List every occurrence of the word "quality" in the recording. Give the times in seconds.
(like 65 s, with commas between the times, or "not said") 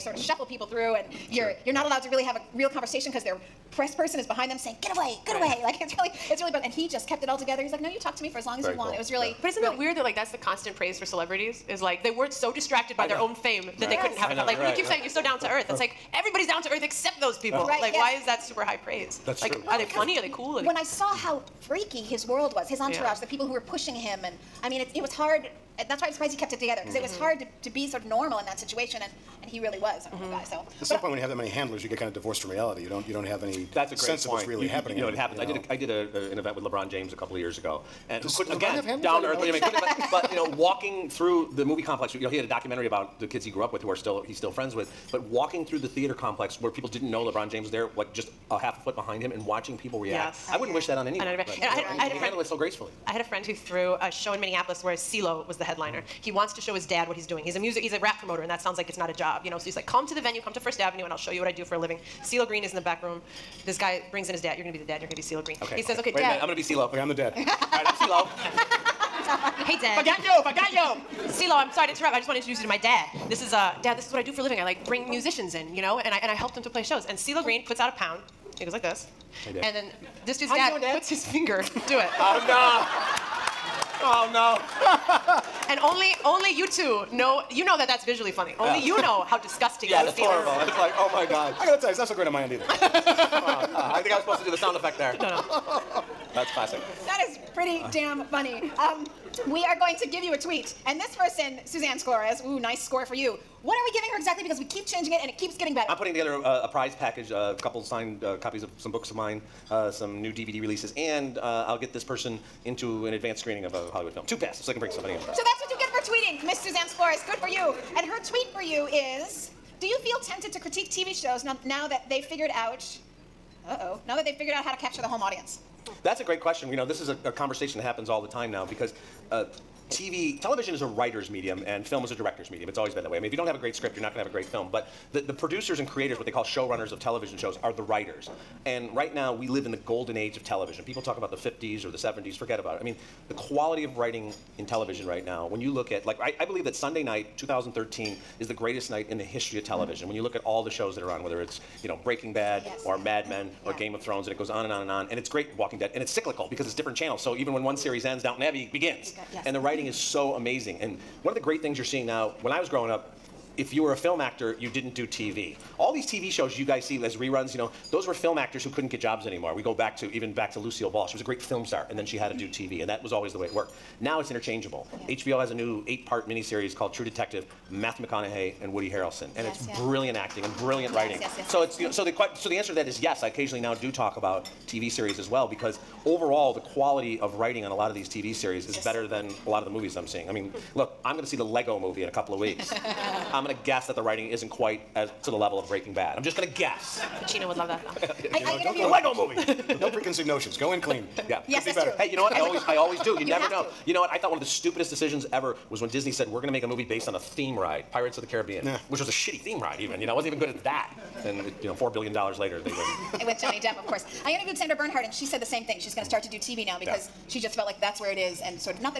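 143 s, 186 s.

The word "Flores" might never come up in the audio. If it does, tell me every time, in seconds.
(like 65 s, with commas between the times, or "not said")
101 s, 116 s.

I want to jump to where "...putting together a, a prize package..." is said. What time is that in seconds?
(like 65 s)
105 s.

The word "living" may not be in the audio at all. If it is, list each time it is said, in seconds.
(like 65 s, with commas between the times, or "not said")
61 s, 74 s.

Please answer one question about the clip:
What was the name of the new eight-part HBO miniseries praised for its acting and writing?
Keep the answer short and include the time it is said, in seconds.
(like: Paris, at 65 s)
True Detective, at 176 s.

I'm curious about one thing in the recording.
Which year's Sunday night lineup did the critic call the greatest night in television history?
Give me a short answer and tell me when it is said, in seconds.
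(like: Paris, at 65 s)
2013, at 147 s.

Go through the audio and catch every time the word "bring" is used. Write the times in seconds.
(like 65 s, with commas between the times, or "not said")
64 s, 74 s, 114 s.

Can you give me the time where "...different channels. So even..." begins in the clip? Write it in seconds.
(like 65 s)
156 s.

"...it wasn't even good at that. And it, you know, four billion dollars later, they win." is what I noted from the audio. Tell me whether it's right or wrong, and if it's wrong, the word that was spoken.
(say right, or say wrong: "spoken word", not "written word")
right.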